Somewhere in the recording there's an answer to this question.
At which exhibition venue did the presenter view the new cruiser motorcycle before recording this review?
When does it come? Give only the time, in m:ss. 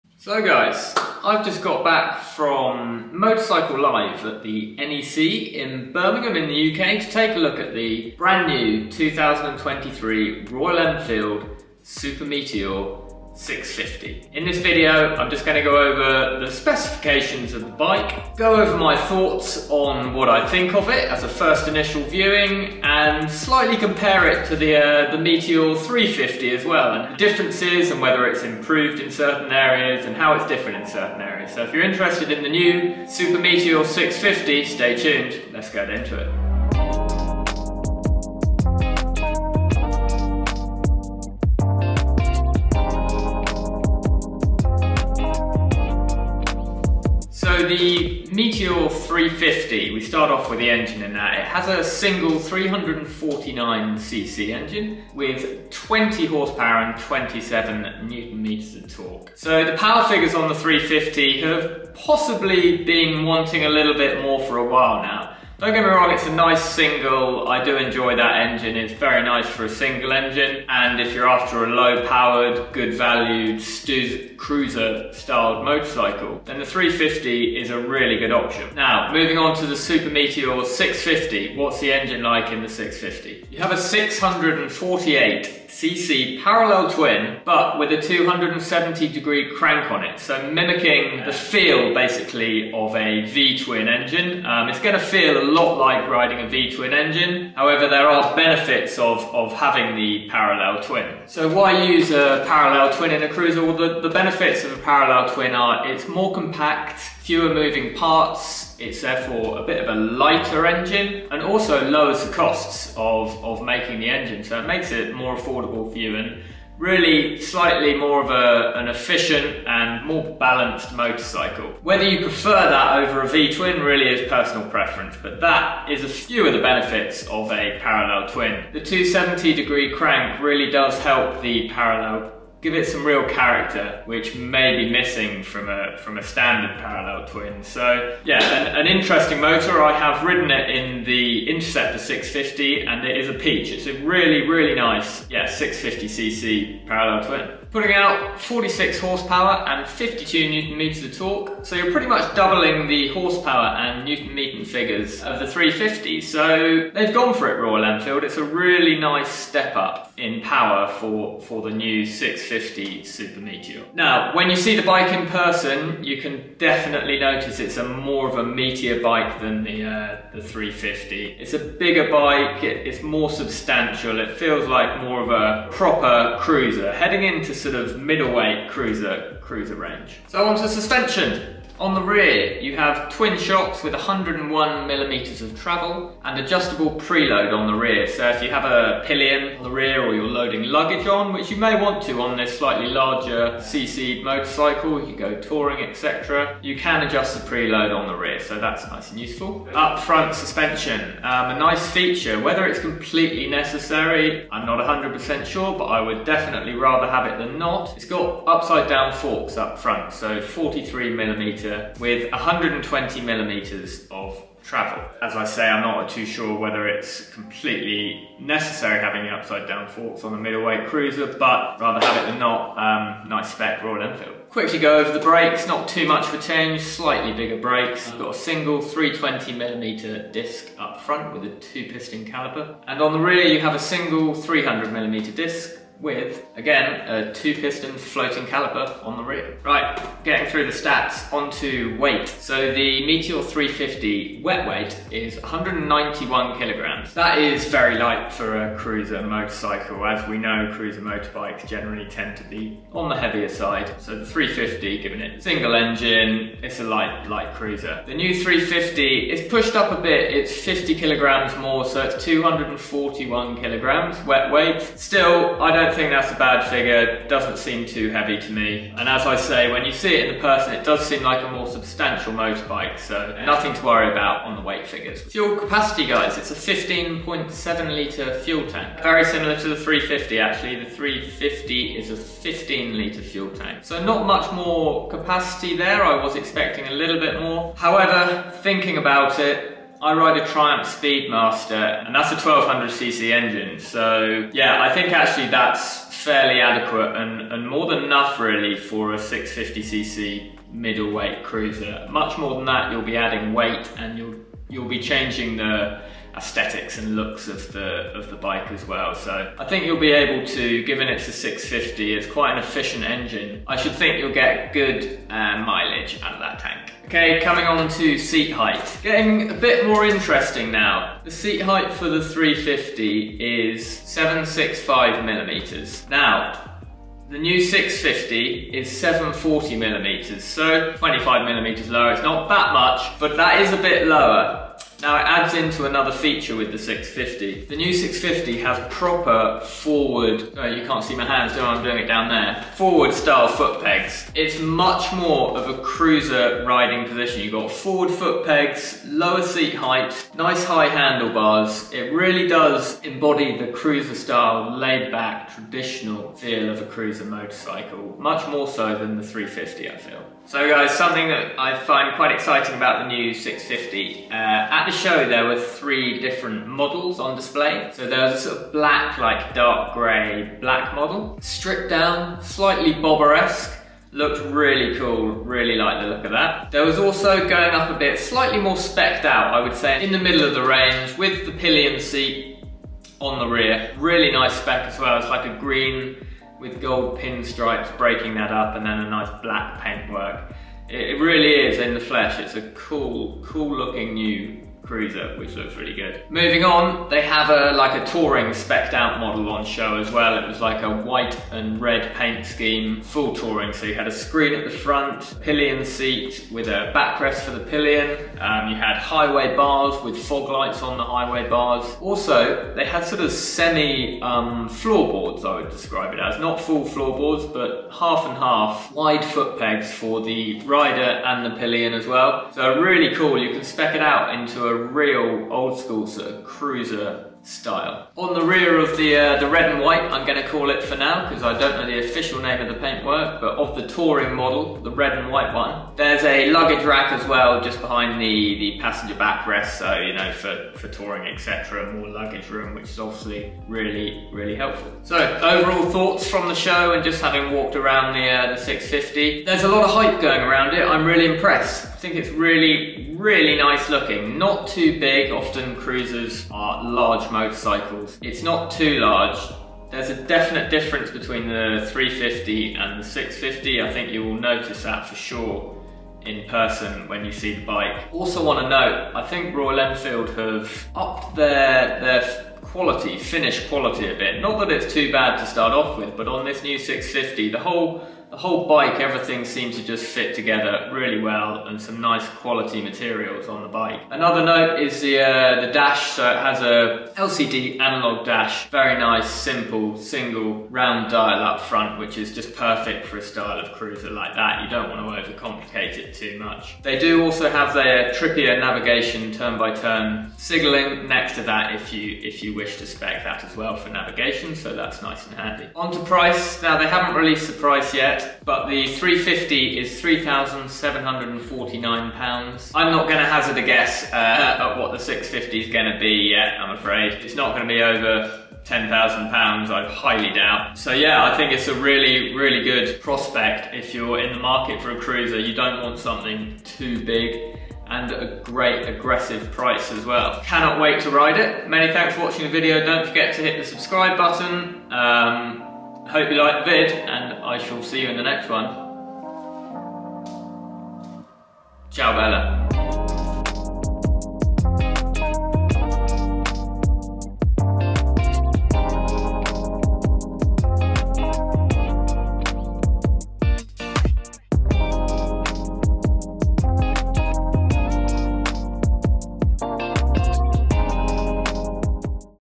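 0:04.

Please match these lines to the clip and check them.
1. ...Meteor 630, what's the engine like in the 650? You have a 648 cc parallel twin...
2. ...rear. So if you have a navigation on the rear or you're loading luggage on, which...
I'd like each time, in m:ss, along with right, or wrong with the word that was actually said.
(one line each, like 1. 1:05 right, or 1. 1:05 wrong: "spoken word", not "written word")
1. 1:20 wrong: "650", not "630"
2. 3:07 wrong: "pillion", not "navigation".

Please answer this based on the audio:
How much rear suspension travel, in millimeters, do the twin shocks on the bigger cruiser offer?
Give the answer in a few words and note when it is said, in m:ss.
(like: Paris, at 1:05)
101 millimeters, at 3:03.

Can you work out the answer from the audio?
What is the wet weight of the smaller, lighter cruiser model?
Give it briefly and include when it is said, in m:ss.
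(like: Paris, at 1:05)
191 kilograms, at 4:05.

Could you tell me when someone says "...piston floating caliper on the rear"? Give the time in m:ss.
3:57.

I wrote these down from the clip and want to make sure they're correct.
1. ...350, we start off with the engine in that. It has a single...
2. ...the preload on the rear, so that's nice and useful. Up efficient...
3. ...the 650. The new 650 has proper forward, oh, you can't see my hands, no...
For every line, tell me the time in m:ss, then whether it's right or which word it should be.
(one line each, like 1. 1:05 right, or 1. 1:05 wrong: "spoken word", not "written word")
1. 0:48 right
2. 3:17 wrong: "front", not "efficient"
3. 5:36 right.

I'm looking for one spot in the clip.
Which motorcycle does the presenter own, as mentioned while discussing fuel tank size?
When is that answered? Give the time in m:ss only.
4:50.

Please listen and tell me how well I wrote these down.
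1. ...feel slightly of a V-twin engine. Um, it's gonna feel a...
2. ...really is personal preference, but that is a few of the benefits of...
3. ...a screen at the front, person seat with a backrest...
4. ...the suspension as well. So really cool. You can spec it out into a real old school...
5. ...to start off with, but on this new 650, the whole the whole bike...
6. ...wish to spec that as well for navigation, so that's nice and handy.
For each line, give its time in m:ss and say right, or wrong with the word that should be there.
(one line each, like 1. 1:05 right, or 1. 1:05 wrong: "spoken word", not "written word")
1. 1:31 wrong: "basically", not "slightly"
2. 2:03 right
3. 6:44 wrong: "pillion", not "person"
4. 7:01 wrong: "pillion", not "suspension"
5. 7:55 right
6. 8:22 right.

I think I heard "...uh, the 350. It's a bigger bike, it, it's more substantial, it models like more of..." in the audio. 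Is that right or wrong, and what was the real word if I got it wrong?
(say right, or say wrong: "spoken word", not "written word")
wrong: "feels", not "models".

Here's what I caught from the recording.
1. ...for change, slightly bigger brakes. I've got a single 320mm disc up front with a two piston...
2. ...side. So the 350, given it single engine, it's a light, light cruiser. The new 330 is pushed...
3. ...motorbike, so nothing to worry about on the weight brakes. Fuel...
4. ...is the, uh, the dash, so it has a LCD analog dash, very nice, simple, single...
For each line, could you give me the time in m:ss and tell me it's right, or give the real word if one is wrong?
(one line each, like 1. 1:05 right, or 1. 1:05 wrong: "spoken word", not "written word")
1. 3:46 right
2. 4:13 wrong: "350", not "330"
3. 4:32 wrong: "figures", not "brakes"
4. 8:04 right.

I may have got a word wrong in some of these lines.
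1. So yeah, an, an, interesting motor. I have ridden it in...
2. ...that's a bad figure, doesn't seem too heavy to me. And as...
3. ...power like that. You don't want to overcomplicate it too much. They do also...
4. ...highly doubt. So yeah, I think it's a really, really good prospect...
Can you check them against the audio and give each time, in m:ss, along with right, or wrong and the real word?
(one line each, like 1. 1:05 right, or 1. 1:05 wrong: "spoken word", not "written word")
1. 2:17 right
2. 4:26 right
3. 8:13 wrong: "cruiser", not "power"
4. 8:39 right.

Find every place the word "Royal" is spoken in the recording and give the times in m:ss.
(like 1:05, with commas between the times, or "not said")
0:10, 2:37, 3:43, 7:49.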